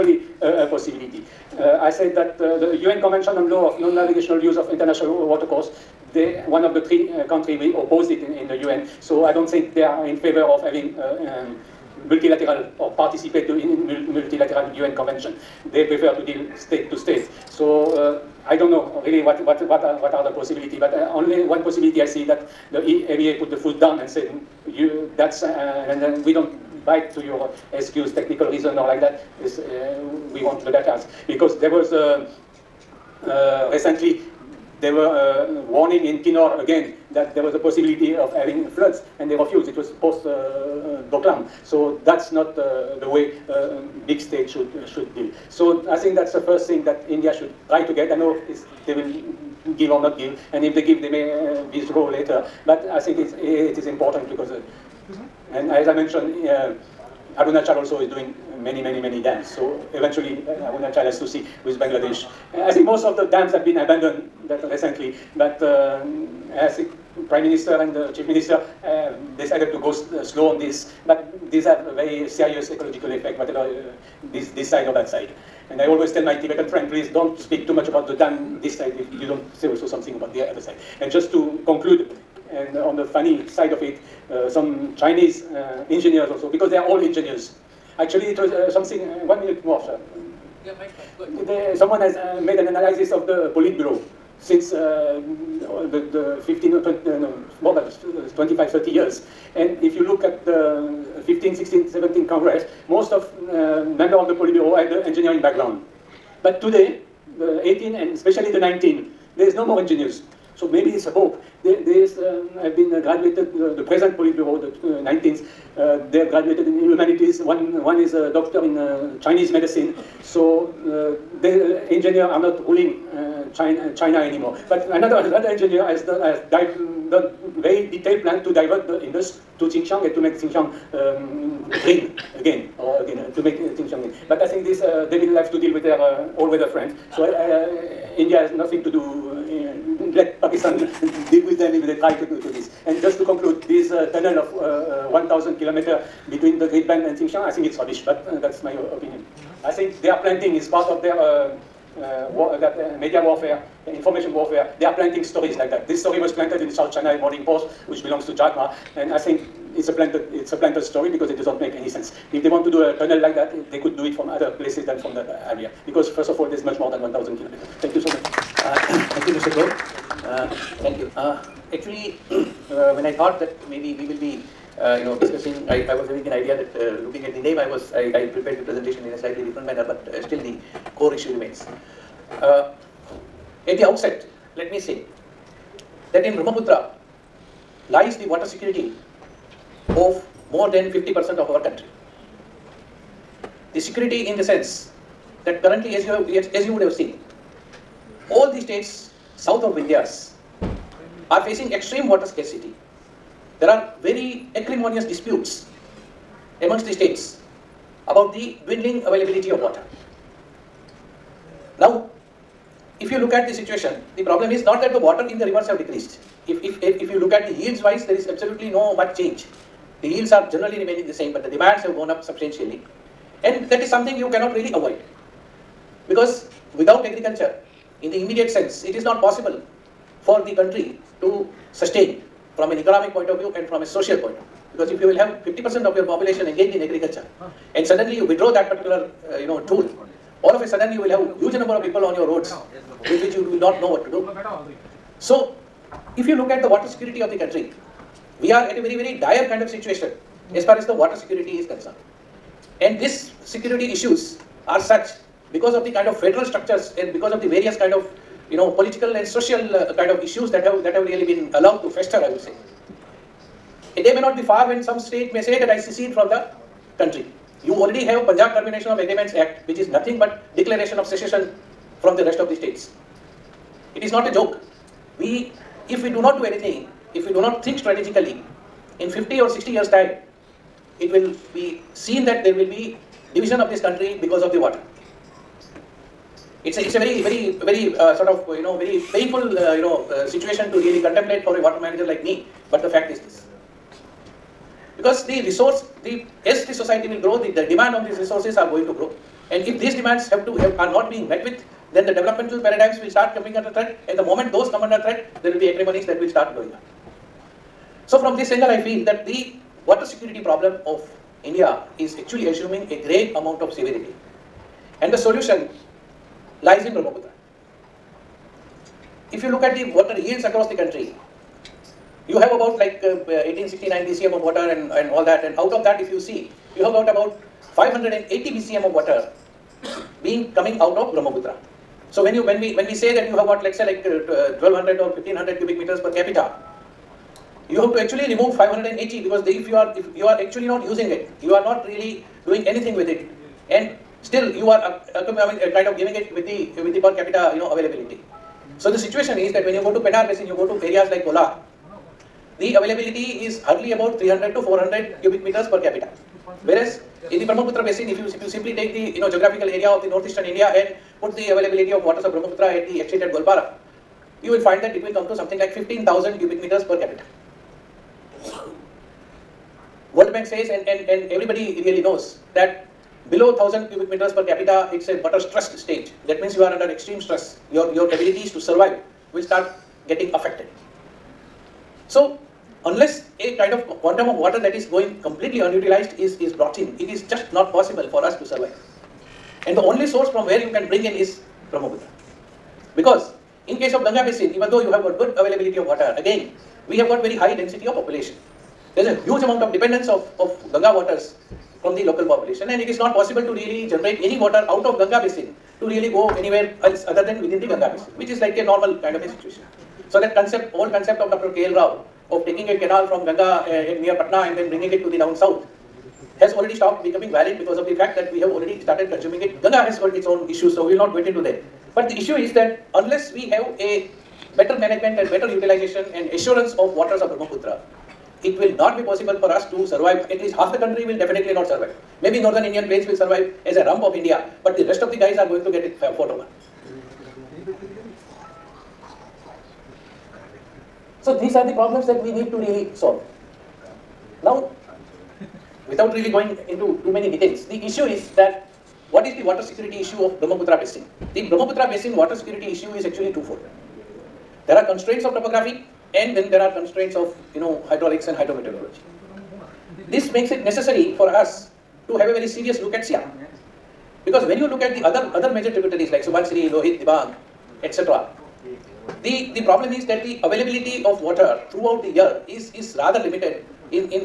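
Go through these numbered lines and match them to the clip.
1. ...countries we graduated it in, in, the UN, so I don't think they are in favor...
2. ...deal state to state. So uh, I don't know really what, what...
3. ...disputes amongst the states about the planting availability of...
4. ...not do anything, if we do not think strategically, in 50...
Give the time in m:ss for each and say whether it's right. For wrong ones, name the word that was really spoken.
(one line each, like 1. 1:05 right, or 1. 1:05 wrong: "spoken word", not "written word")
1. 0:07 wrong: "opposed", not "graduated"
2. 0:16 right
3. 3:25 wrong: "dwindling", not "planting"
4. 4:36 right.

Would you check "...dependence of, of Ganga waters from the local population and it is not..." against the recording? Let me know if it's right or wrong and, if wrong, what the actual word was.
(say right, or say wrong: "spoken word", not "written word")
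right.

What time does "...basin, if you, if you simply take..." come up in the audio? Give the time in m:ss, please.
5:57.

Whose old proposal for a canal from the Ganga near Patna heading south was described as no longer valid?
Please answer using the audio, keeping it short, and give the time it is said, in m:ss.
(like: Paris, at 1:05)
Dr. K.L. Rao, at 6:51.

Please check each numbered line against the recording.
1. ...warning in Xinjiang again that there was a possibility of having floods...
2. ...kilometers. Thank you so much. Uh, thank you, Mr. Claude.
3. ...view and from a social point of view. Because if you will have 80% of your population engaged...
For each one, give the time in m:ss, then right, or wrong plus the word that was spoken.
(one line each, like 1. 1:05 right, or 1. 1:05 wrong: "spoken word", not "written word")
1. 0:35 wrong: "Kinnaur", not "Xinjiang"
2. 2:47 right
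3. 3:53 wrong: "50", not "80".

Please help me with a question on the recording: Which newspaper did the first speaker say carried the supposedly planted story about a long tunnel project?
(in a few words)
South China Morning Post.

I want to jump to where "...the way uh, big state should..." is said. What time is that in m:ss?
0:43.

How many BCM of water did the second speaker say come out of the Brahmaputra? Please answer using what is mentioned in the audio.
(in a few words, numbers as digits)
580 BCM.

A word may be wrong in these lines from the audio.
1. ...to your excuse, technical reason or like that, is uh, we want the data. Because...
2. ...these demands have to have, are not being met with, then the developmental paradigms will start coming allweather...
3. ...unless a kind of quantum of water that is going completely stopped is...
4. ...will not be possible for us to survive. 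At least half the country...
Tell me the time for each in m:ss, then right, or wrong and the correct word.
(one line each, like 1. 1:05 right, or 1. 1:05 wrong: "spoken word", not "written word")
1. 0:27 right
2. 4:59 wrong: "under", not "allweather"
3. 6:22 wrong: "unutilized", not "stopped"
4. 7:08 right.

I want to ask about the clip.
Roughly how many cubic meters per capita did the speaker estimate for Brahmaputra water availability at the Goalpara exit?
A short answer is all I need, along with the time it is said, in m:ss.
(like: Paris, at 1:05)
15,000, at 6:05.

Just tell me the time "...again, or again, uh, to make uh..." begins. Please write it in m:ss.
2:11.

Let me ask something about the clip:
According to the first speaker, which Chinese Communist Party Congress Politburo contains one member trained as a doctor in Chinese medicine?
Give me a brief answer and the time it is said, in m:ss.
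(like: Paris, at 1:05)
19th, at 1:54.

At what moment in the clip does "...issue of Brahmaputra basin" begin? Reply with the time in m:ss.
7:30.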